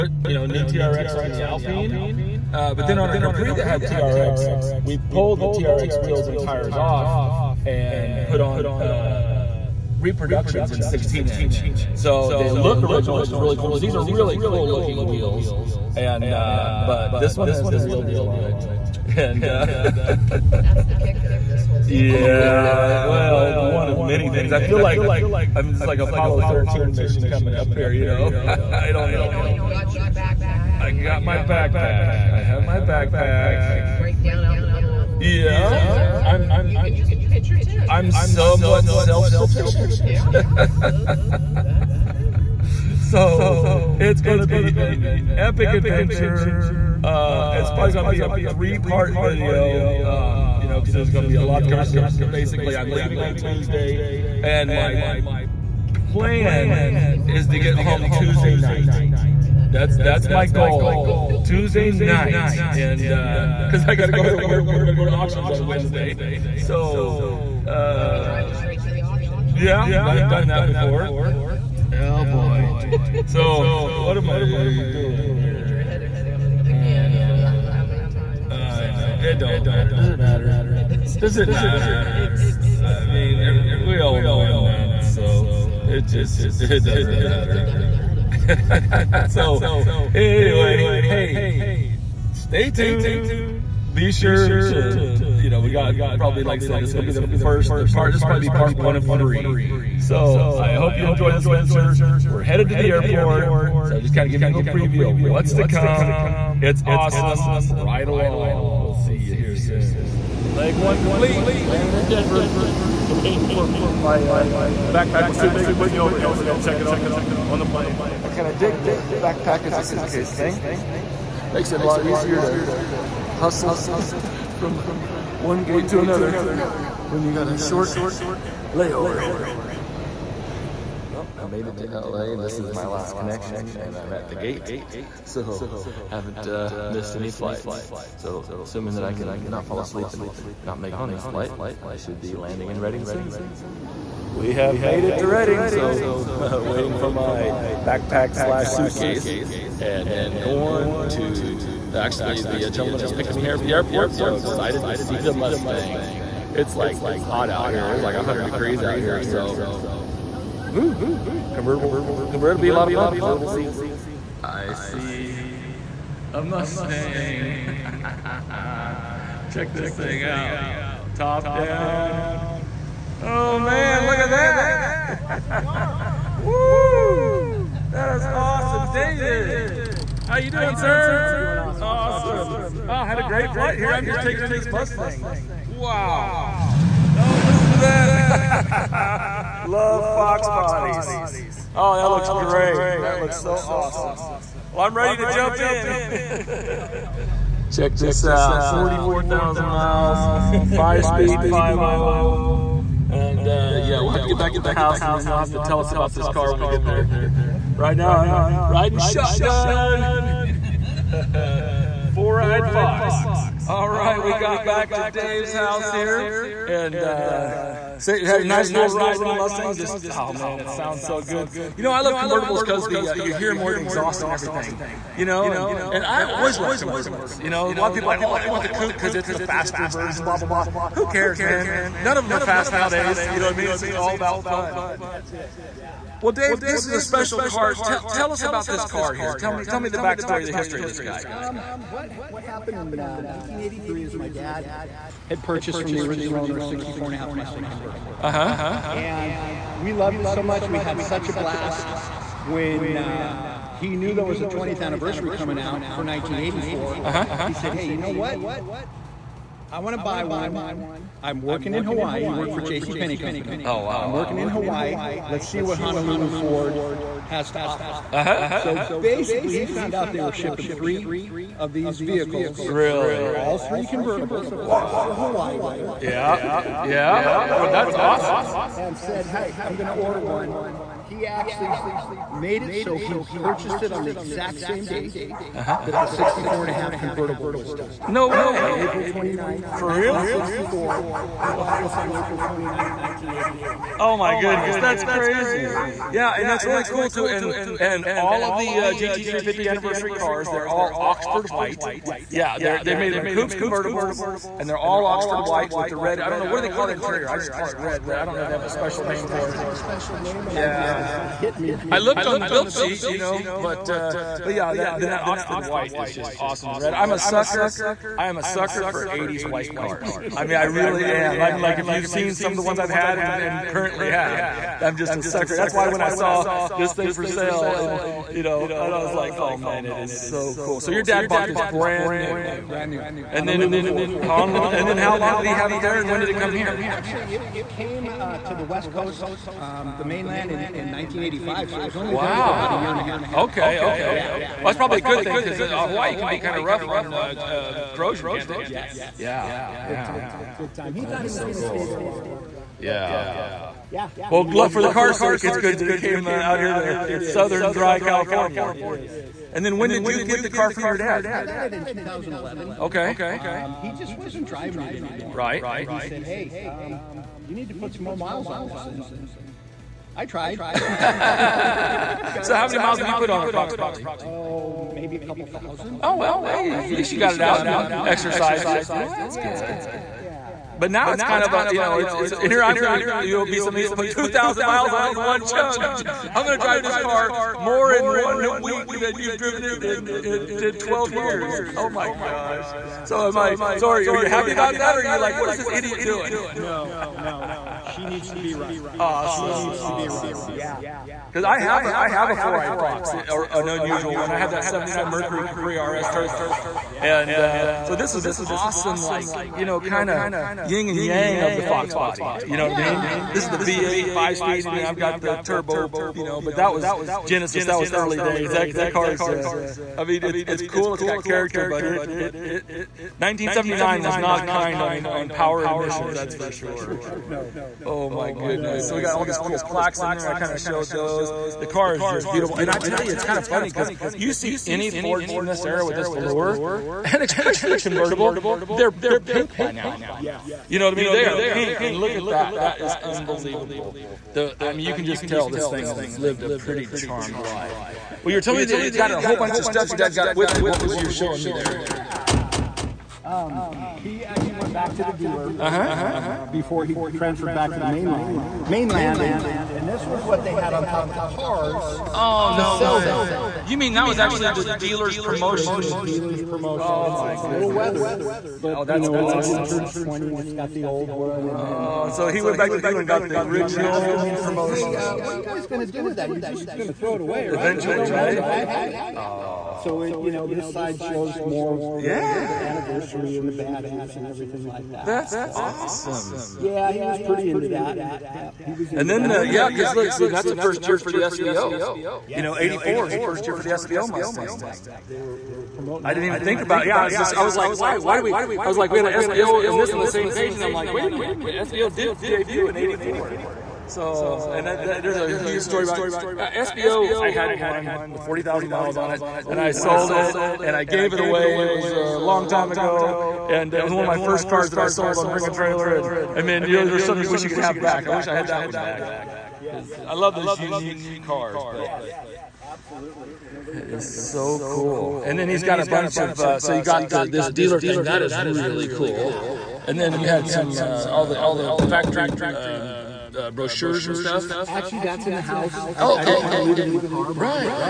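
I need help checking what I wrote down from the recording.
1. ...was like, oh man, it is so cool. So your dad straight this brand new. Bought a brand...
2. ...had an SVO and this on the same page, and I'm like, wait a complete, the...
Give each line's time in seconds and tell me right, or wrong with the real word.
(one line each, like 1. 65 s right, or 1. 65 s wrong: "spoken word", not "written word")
1. 329 s wrong: "bought", not "straight"
2. 498 s wrong: "minute", not "complete".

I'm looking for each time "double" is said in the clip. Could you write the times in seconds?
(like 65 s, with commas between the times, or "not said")
not said.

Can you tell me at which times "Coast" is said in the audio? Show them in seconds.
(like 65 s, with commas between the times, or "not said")
338 s.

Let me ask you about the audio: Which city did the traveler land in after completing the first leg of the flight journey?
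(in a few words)
Denver.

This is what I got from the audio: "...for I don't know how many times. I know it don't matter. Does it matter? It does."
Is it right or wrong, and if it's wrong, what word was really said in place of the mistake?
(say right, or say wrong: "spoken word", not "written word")
right.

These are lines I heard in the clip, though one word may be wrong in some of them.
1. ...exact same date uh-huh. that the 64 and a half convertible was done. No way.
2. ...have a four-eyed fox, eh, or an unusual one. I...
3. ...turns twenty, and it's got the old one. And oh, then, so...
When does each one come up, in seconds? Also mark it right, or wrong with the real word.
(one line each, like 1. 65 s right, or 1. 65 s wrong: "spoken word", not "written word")
1. 284 s right
2. 402 s right
3. 469 s right.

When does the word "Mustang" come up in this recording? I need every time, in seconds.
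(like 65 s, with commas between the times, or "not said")
155 s, 166 s, 184 s, 219 s, 247 s, 494 s.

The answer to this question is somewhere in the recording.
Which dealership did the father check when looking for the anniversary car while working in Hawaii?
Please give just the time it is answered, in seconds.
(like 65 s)
265 s.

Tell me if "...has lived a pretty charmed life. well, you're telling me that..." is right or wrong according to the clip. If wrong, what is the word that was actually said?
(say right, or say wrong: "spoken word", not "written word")
right.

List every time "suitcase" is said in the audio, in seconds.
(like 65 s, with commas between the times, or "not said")
119 s, 148 s.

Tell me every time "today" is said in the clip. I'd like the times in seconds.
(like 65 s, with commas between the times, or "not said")
not said.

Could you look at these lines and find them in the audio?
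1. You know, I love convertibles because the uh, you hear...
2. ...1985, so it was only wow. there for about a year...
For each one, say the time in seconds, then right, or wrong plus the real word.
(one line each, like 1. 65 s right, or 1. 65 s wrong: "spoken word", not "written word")
1. 221 s right
2. 340 s right.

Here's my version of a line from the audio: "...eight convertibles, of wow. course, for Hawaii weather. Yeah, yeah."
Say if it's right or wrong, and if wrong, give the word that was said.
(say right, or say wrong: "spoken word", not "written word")
wrong: "three", not "eight".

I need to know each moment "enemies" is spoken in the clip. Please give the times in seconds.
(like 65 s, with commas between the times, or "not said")
not said.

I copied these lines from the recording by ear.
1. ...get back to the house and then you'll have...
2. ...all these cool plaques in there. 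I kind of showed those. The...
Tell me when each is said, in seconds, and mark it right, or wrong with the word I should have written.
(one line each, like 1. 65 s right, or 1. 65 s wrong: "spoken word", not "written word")
1. 204 s right
2. 429 s right.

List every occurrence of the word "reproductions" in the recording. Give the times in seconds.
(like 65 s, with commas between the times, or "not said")
9 s.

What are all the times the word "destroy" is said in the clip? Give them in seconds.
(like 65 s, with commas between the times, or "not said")
not said.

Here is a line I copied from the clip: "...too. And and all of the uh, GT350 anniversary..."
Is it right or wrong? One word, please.
right.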